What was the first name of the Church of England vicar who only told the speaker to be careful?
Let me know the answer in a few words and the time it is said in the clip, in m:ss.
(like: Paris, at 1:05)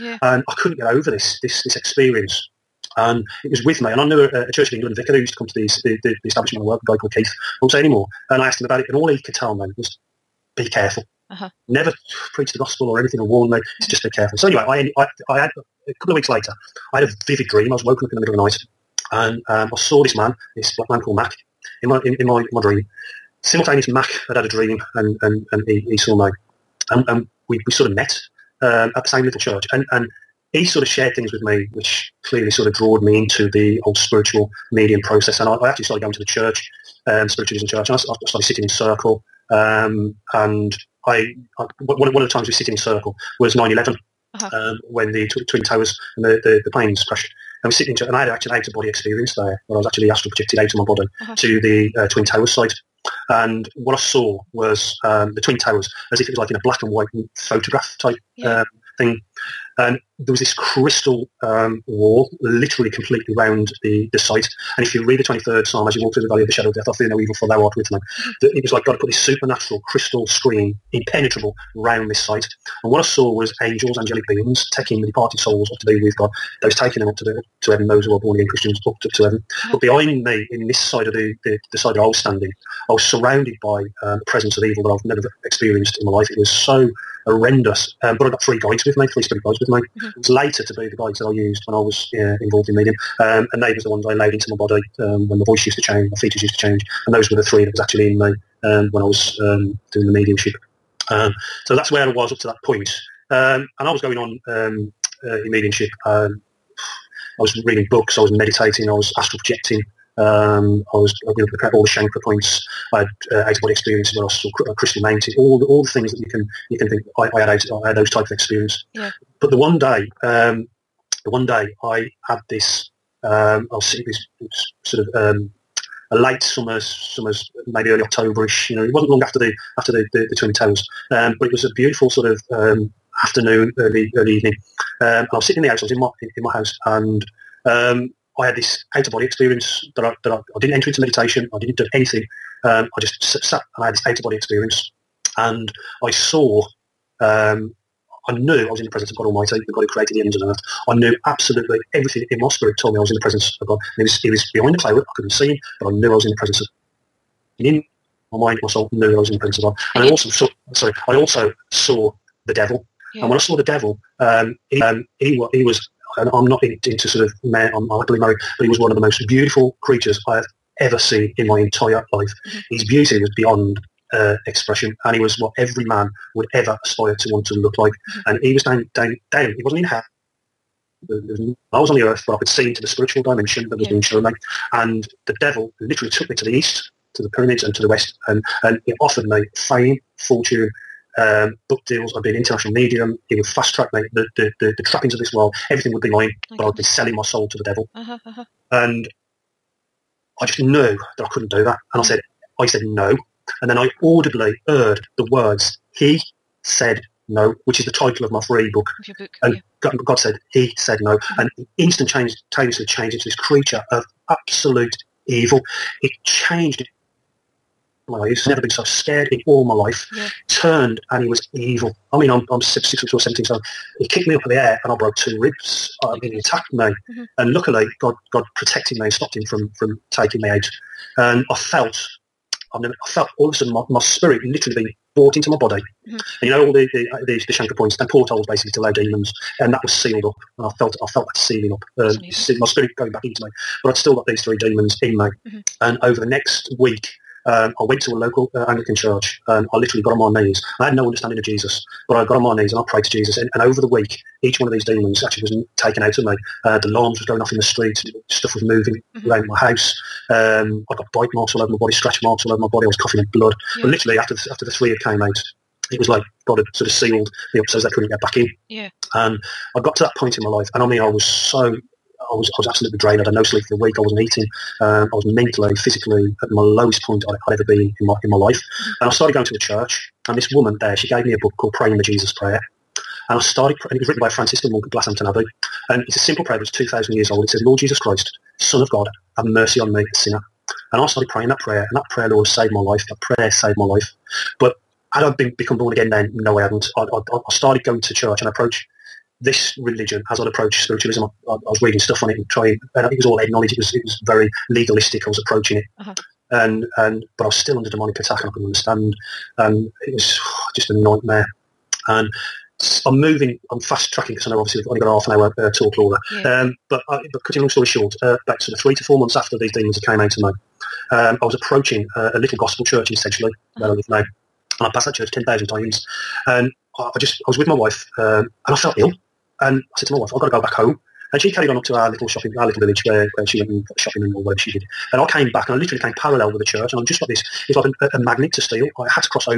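Keith, at 0:06.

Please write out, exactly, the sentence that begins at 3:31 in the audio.
And instantaneously changed into this creature of absolute evil.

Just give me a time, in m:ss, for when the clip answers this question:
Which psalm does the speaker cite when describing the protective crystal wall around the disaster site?
1:05.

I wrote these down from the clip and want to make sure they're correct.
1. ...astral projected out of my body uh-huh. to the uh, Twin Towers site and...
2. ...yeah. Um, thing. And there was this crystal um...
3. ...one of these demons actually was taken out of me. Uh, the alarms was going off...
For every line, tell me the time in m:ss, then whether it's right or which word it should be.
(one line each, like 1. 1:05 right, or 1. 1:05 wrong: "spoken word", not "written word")
1. 0:50 right
2. 0:58 right
3. 4:14 right.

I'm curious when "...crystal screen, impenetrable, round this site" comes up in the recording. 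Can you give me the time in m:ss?
1:09.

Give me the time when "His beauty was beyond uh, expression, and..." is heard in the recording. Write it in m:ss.
2:52.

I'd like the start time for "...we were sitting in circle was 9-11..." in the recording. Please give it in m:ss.
0:42.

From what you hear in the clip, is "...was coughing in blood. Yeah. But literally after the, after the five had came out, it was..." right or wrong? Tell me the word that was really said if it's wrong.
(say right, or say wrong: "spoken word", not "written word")
wrong: "three", not "five".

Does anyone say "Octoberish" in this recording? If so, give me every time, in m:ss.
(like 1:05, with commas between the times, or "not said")
2:08.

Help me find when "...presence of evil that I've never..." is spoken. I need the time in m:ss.
1:24.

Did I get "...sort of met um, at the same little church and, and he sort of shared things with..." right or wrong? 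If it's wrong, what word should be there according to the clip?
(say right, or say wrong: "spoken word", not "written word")
right.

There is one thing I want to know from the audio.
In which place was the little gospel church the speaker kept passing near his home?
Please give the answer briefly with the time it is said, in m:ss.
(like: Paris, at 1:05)
Sedgley, at 5:23.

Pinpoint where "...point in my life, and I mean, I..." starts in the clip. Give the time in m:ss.
4:30.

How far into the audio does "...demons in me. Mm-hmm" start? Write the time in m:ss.
4:04.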